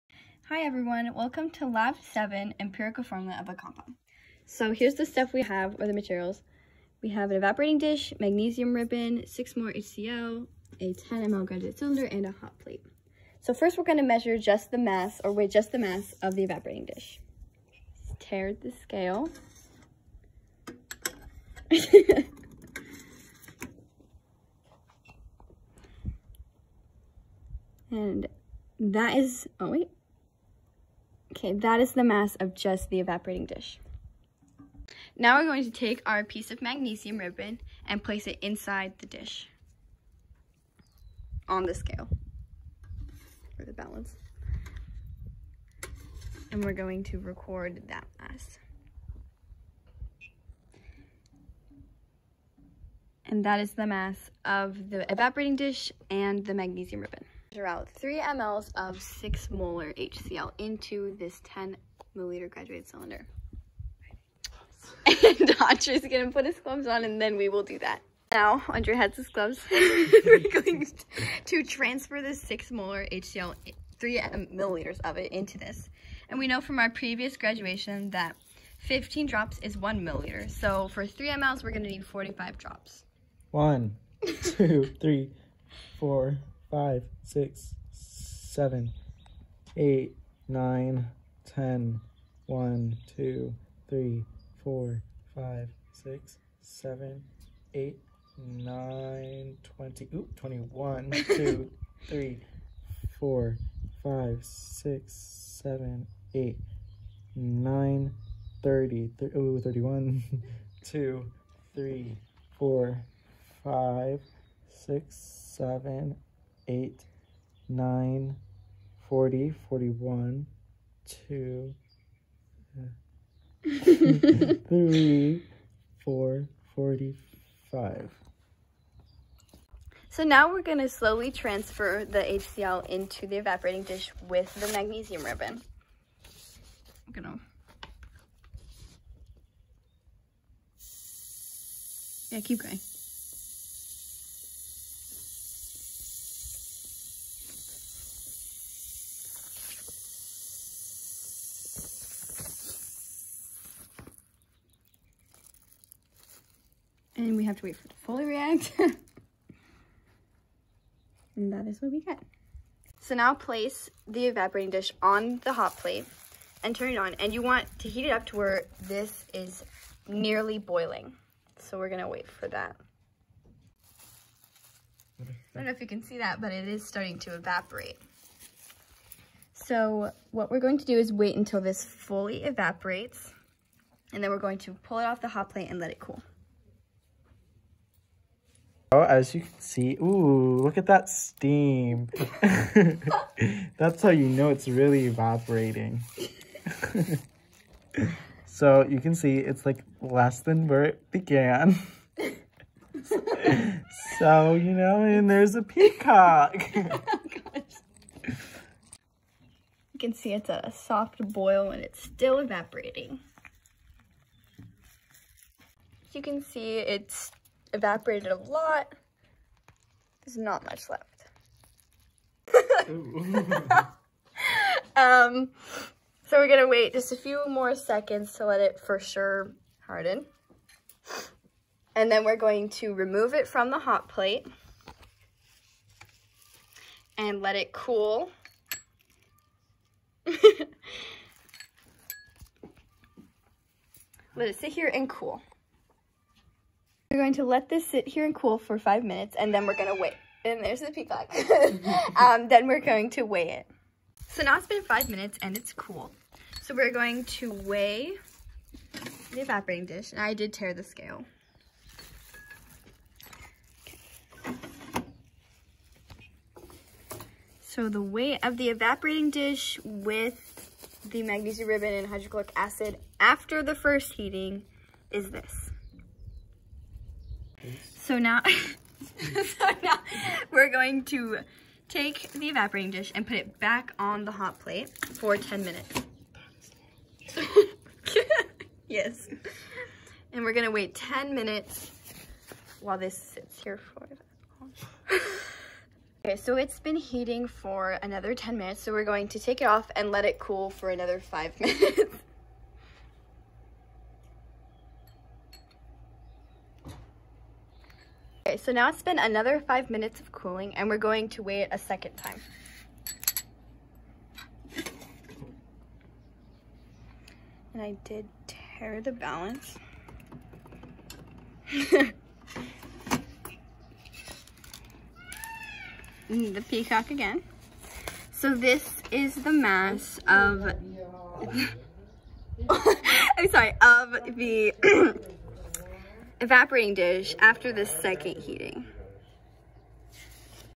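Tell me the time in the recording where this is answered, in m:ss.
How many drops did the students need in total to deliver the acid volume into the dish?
1:21.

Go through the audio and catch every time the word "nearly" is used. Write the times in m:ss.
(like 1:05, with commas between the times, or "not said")
2:50.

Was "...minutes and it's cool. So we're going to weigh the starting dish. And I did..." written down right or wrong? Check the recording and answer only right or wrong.
wrong.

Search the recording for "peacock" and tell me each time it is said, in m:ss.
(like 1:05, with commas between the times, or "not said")
3:25, 4:10, 5:26.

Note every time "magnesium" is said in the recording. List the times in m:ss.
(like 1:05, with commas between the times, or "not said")
0:08, 0:36, 0:56, 2:14, 4:31.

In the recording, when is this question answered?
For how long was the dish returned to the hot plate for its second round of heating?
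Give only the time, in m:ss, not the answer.
4:44.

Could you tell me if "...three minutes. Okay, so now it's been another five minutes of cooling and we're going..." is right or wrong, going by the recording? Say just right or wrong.
wrong.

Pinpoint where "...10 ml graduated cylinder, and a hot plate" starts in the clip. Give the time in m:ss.
0:10.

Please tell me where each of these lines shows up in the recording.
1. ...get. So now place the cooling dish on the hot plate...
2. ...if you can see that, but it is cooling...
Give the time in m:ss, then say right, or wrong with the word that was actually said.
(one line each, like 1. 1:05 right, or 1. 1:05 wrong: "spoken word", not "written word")
1. 2:42 wrong: "evaporating", not "cooling"
2. 2:55 wrong: "starting", not "cooling".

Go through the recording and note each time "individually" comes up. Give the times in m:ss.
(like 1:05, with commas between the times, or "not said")
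not said.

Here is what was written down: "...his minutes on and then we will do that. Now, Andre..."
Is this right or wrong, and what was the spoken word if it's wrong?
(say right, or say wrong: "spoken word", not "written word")
wrong: "gloves", not "minutes".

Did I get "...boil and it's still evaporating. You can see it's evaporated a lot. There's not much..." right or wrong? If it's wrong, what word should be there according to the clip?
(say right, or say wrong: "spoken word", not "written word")
right.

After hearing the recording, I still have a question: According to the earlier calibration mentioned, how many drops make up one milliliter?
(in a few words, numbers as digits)
15.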